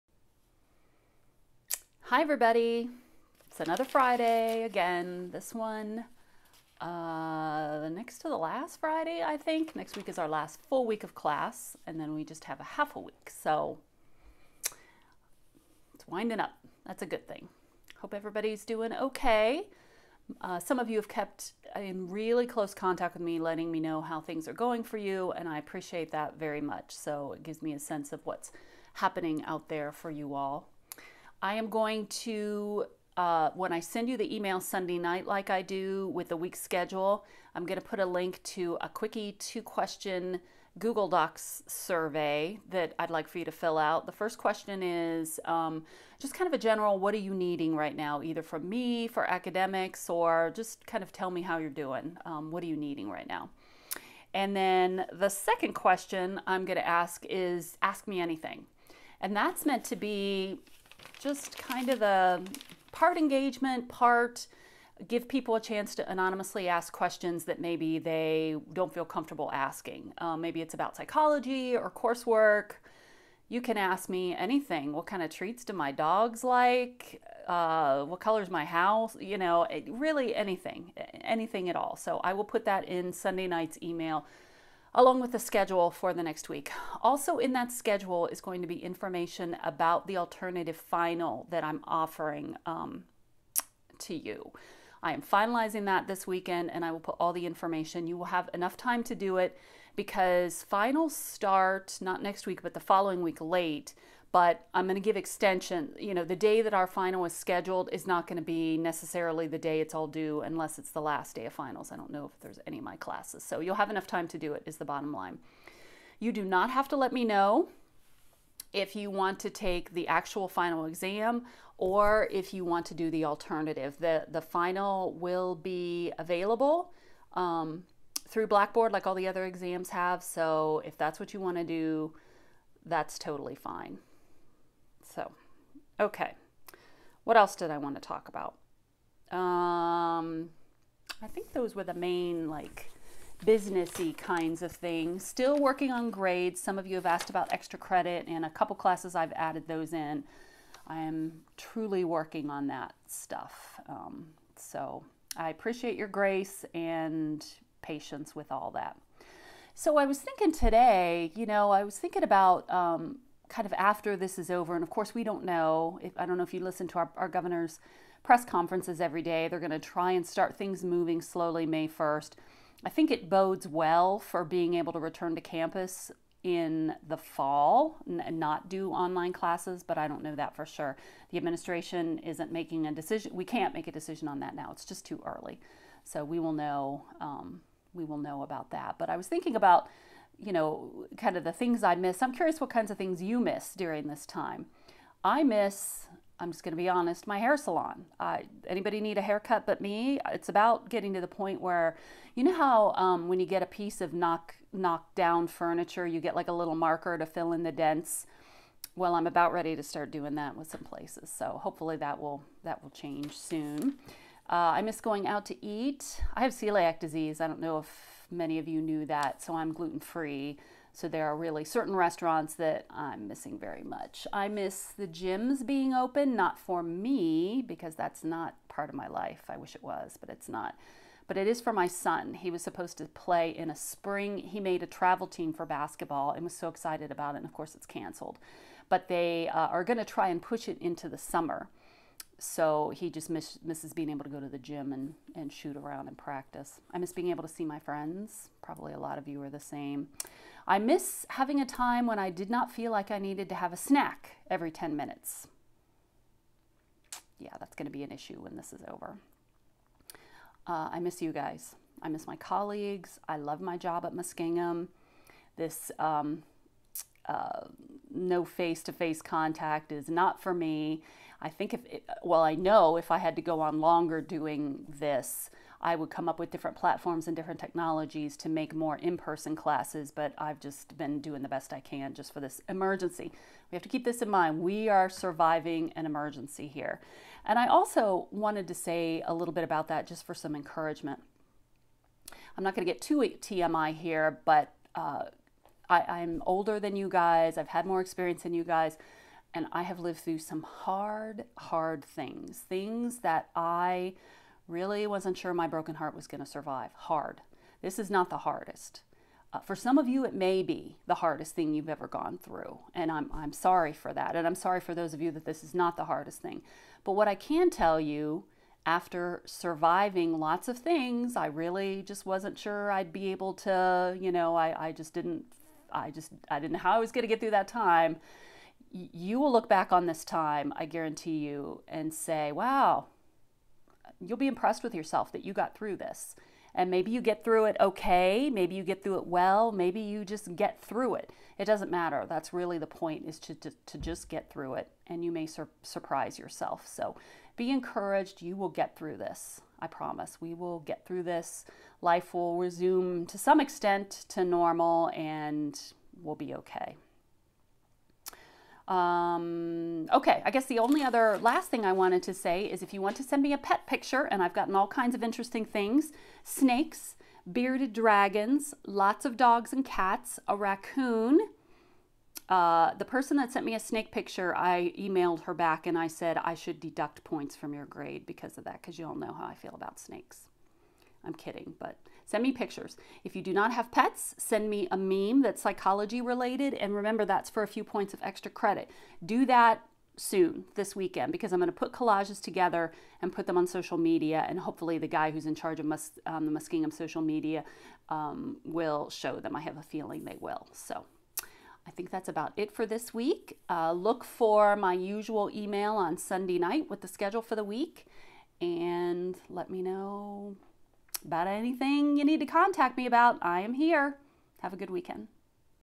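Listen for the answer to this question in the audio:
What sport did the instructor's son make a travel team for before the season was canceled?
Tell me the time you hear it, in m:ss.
3:55.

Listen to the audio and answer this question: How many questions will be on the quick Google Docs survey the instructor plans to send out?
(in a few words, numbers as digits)
2.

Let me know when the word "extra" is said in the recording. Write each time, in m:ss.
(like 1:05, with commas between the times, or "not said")
2:27, 6:28.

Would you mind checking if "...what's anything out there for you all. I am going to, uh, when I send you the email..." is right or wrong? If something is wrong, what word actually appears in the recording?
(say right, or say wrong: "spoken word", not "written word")
wrong: "happening", not "anything".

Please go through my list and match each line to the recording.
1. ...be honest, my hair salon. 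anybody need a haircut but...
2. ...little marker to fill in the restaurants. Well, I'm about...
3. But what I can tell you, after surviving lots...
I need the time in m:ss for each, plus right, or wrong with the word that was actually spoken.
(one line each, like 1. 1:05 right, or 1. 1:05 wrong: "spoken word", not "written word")
1. 3:16 right
2. 3:26 wrong: "dents", not "restaurants"
3. 5:17 right.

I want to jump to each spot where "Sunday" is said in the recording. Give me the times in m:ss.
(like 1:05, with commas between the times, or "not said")
0:34, 1:23, 6:46.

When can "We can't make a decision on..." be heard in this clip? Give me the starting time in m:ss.
3:03.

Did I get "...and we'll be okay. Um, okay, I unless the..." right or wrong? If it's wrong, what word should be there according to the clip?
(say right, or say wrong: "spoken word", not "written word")
wrong: "guess", not "unless".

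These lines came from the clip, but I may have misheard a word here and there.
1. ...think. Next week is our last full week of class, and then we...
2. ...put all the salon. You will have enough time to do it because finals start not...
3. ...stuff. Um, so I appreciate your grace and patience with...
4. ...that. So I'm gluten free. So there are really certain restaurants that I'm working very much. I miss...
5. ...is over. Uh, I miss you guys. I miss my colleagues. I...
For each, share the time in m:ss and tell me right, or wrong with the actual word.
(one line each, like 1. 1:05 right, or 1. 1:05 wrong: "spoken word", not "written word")
1. 0:09 right
2. 1:36 wrong: "information", not "salon"
3. 2:33 right
4. 3:39 wrong: "missing", not "working"
5. 4:18 right.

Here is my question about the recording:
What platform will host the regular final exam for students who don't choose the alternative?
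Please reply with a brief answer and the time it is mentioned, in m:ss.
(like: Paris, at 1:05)
Blackboard, at 2:08.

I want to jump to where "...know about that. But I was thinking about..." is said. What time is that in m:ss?
3:08.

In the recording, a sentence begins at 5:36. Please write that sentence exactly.
And maybe you get through it okay, maybe you get through it well, maybe you just get through it.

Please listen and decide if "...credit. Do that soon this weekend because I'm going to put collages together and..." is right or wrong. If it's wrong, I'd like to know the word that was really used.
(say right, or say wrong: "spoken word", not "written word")
right.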